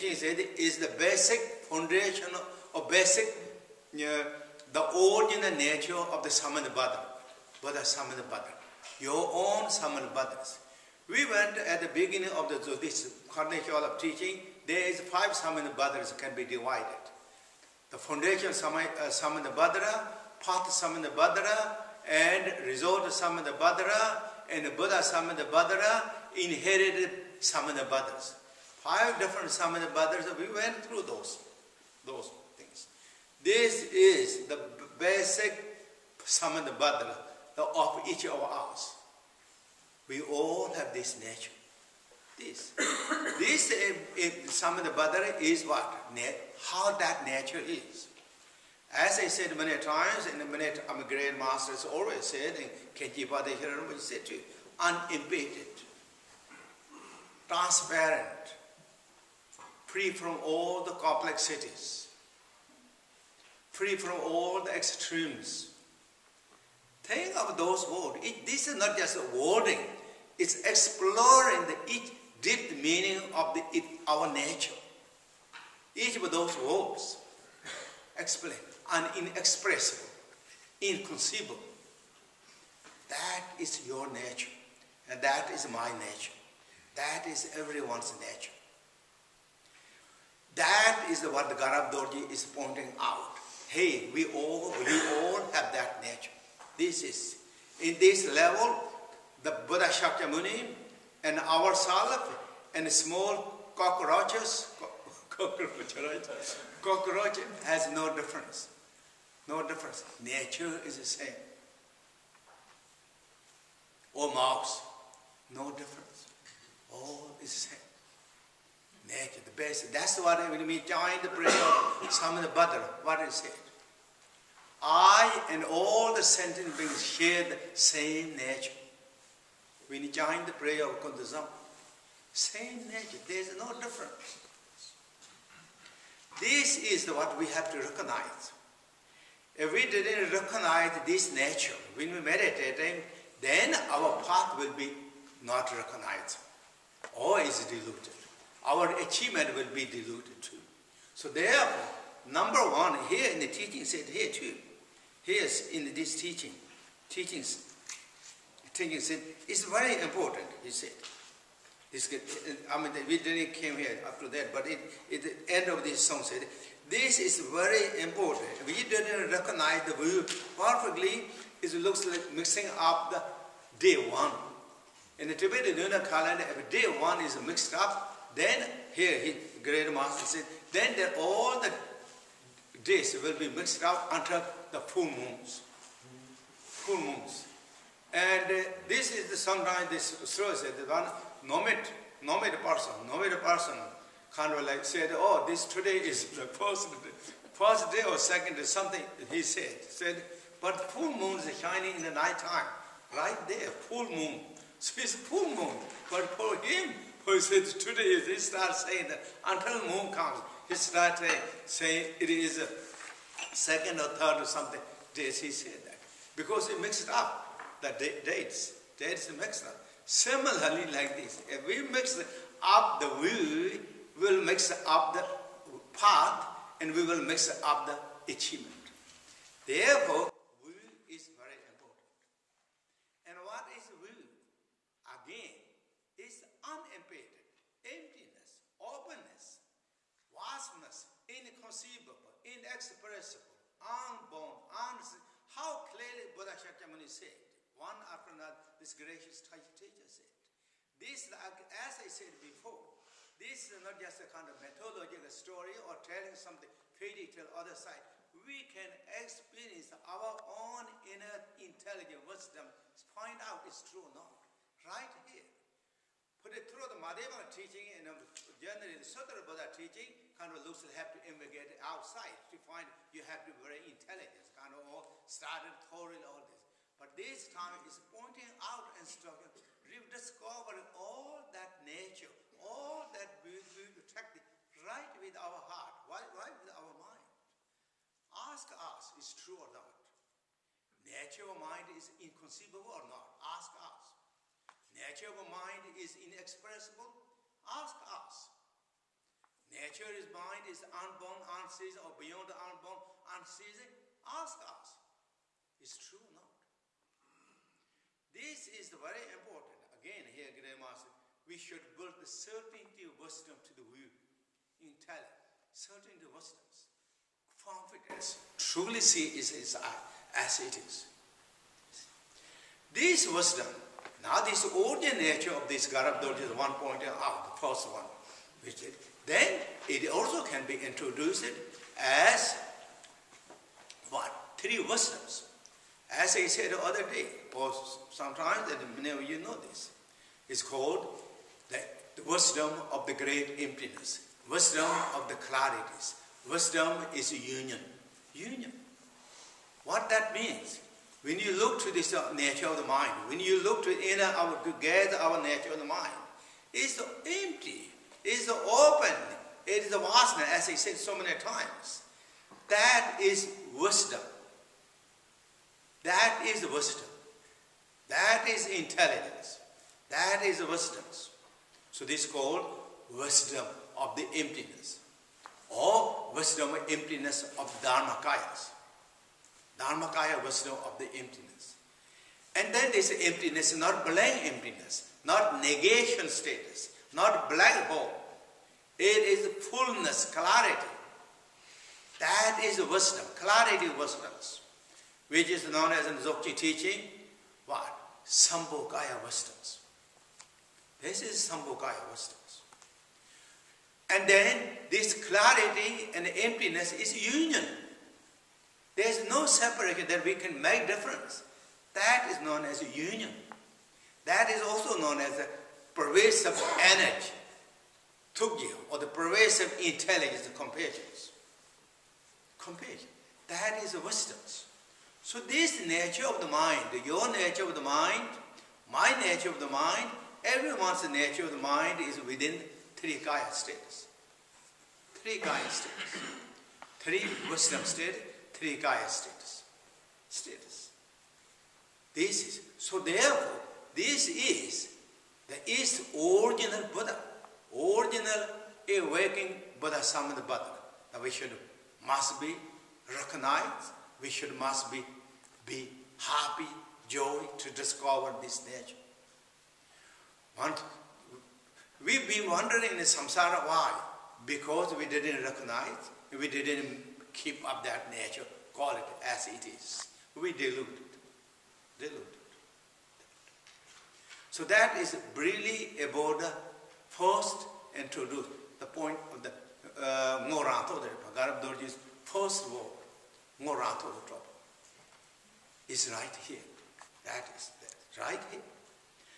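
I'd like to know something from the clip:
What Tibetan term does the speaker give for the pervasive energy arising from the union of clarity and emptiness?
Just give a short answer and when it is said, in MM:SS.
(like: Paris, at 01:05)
Tugya, at 06:58.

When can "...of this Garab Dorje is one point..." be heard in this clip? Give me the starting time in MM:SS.
05:25.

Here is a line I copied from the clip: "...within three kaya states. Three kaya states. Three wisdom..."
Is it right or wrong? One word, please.
right.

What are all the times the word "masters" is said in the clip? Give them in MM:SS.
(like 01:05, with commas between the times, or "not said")
00:51, 02:59, 05:10.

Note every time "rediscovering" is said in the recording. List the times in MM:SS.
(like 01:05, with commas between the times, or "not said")
04:39.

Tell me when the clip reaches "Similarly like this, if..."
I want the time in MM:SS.
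03:40.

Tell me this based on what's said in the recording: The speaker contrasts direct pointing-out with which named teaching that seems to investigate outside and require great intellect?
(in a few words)
Madhyavan teaching.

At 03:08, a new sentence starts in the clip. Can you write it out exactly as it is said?
And uh, this is the sometimes this shows said.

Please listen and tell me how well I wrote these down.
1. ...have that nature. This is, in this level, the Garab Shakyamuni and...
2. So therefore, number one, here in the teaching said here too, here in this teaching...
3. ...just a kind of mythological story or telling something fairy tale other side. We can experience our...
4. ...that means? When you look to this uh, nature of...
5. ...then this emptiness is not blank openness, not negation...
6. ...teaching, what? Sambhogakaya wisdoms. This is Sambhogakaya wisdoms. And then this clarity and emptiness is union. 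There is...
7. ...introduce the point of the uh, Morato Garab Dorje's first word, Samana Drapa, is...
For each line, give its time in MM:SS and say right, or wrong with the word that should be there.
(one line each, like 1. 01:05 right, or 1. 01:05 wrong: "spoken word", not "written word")
1. 01:35 wrong: "Buddha", not "Garab"
2. 02:31 right
3. 04:14 right
4. 05:50 right
5. 06:22 wrong: "emptiness", not "openness"
6. 06:36 right
7. 07:57 wrong: "Morato", not "Samana".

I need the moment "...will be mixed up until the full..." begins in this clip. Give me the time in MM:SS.
03:03.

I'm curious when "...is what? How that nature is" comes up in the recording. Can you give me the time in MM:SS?
00:45.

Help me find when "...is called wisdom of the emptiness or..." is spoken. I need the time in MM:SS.
06:12.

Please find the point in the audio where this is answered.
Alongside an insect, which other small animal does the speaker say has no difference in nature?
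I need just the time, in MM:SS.
01:54.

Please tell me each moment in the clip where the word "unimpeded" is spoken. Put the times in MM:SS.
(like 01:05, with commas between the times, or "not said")
00:54, 03:56.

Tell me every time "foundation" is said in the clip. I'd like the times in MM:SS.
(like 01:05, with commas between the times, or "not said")
00:01, 00:17.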